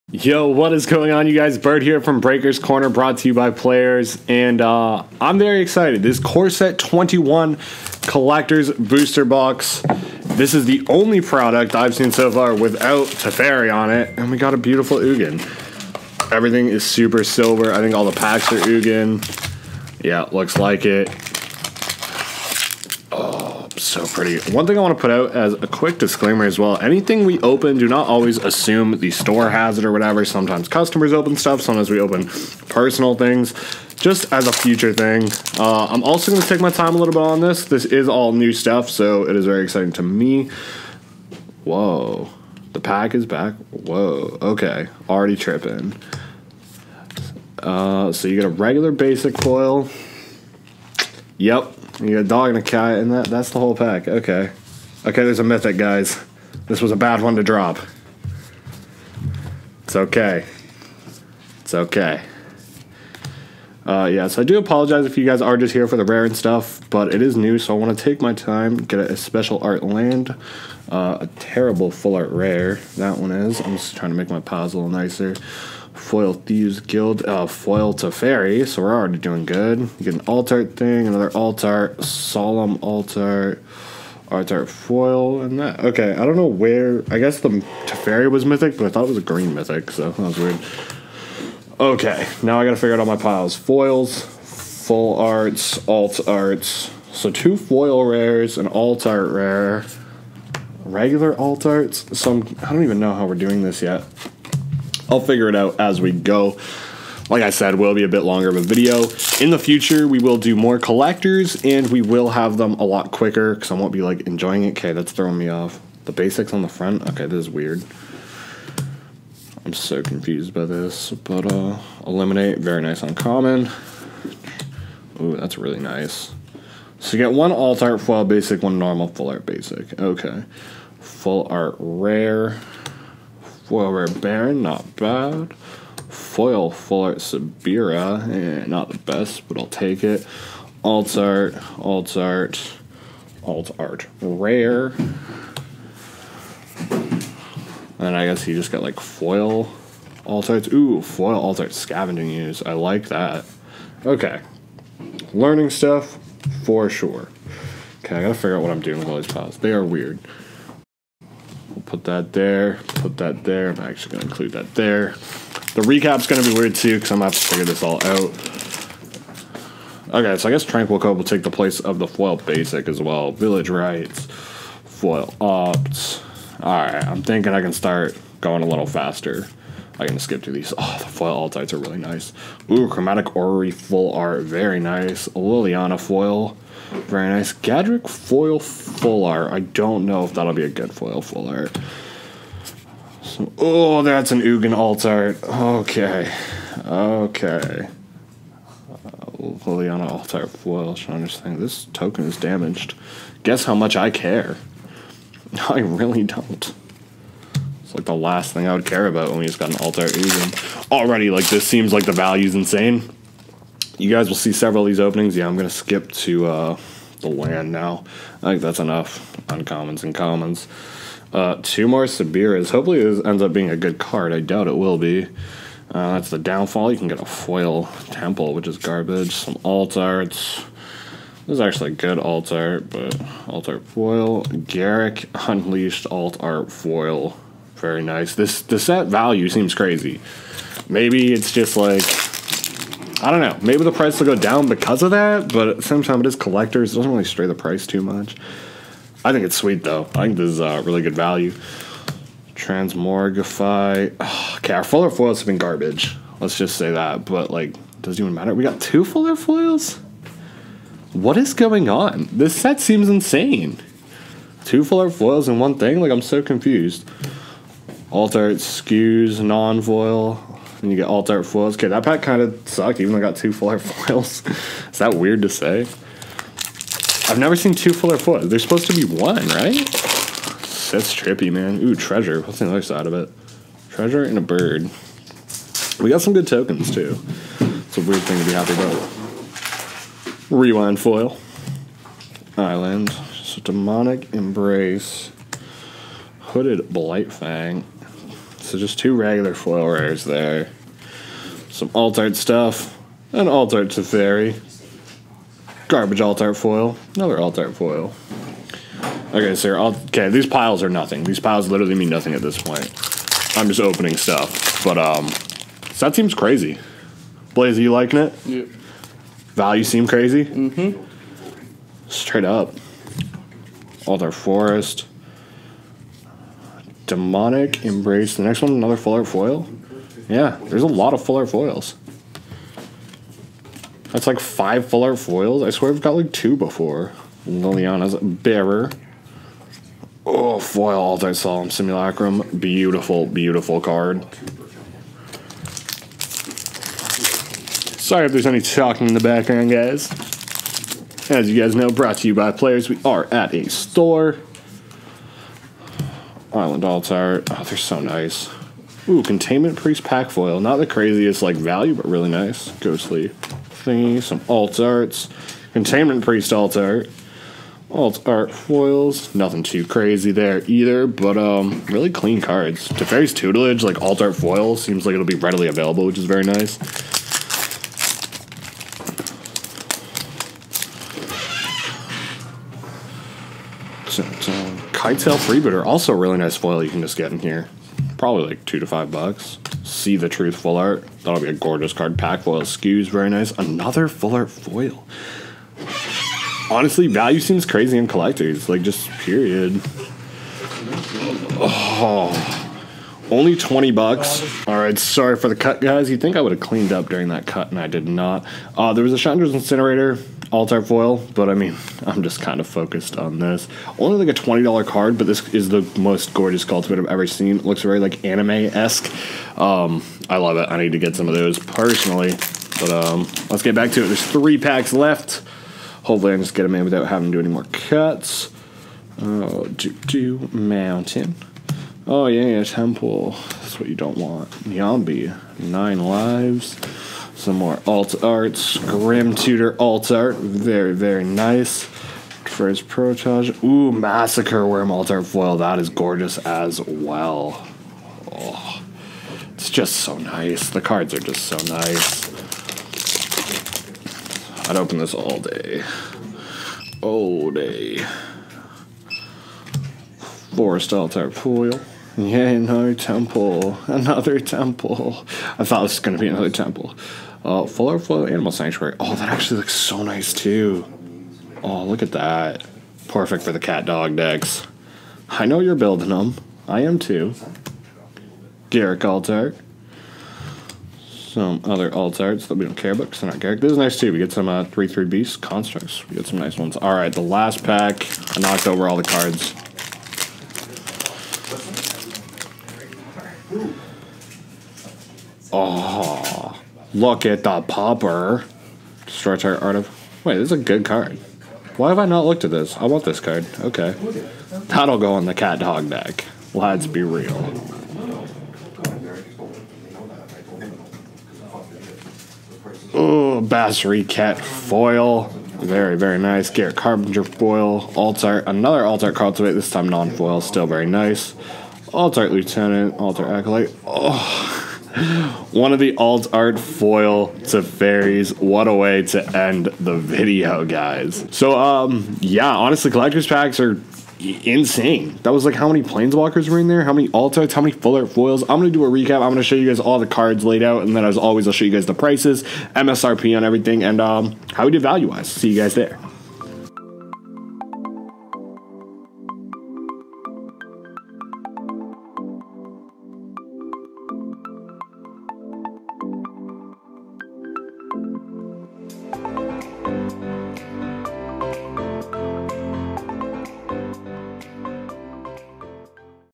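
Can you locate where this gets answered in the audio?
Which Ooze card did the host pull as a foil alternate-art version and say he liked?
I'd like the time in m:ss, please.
2:31.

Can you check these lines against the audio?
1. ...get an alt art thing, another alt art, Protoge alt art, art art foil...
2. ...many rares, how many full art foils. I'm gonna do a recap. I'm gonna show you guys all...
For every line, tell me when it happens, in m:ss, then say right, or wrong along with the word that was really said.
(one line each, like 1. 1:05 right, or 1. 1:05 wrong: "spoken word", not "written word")
1. 1:20 wrong: "Solemn", not "Protoge"
2. 8:56 wrong: "altites", not "rares".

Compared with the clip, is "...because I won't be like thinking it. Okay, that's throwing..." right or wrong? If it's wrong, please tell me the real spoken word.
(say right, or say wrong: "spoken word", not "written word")
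wrong: "enjoying", not "thinking".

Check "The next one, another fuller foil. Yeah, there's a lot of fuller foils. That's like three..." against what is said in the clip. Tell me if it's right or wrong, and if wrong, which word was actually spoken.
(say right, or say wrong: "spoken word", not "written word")
wrong: "five", not "three".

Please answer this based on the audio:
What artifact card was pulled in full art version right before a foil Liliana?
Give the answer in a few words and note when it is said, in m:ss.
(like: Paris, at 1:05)
Chromatic Orrery, at 3:02.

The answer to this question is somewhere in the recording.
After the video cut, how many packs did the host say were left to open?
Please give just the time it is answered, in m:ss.
7:04.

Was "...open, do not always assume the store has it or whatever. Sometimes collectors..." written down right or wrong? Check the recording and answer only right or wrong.
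wrong.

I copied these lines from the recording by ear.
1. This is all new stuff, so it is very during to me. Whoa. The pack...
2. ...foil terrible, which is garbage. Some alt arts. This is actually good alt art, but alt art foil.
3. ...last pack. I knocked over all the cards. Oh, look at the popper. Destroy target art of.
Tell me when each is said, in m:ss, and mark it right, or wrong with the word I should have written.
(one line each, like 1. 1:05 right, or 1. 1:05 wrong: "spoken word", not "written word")
1. 0:37 wrong: "exciting", not "during"
2. 3:47 wrong: "temple", not "terrible"
3. 8:07 right.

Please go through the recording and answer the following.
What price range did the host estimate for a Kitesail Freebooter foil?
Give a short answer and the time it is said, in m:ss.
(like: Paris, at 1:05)
$2 to $5, at 6:28.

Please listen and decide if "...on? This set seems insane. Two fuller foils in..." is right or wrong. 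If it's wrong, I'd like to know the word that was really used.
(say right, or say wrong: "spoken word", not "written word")
right.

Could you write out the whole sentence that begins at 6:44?
All right, sorry for the cut, guys.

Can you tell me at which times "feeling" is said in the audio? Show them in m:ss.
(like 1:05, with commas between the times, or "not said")
not said.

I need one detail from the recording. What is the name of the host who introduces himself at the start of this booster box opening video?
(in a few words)
Bert.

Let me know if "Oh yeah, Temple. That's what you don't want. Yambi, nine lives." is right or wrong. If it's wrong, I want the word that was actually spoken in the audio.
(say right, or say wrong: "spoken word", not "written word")
right.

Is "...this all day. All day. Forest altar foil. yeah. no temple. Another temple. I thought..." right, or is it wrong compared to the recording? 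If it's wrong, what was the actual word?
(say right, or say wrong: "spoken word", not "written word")
right.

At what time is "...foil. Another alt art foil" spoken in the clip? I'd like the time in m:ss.
5:06.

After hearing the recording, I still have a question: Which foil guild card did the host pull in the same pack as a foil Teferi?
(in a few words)
Thieves Guild.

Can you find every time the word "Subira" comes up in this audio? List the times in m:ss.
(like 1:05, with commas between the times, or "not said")
2:17, 3:42.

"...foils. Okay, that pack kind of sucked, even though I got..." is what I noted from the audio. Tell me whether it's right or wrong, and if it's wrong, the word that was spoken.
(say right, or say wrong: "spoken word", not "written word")
right.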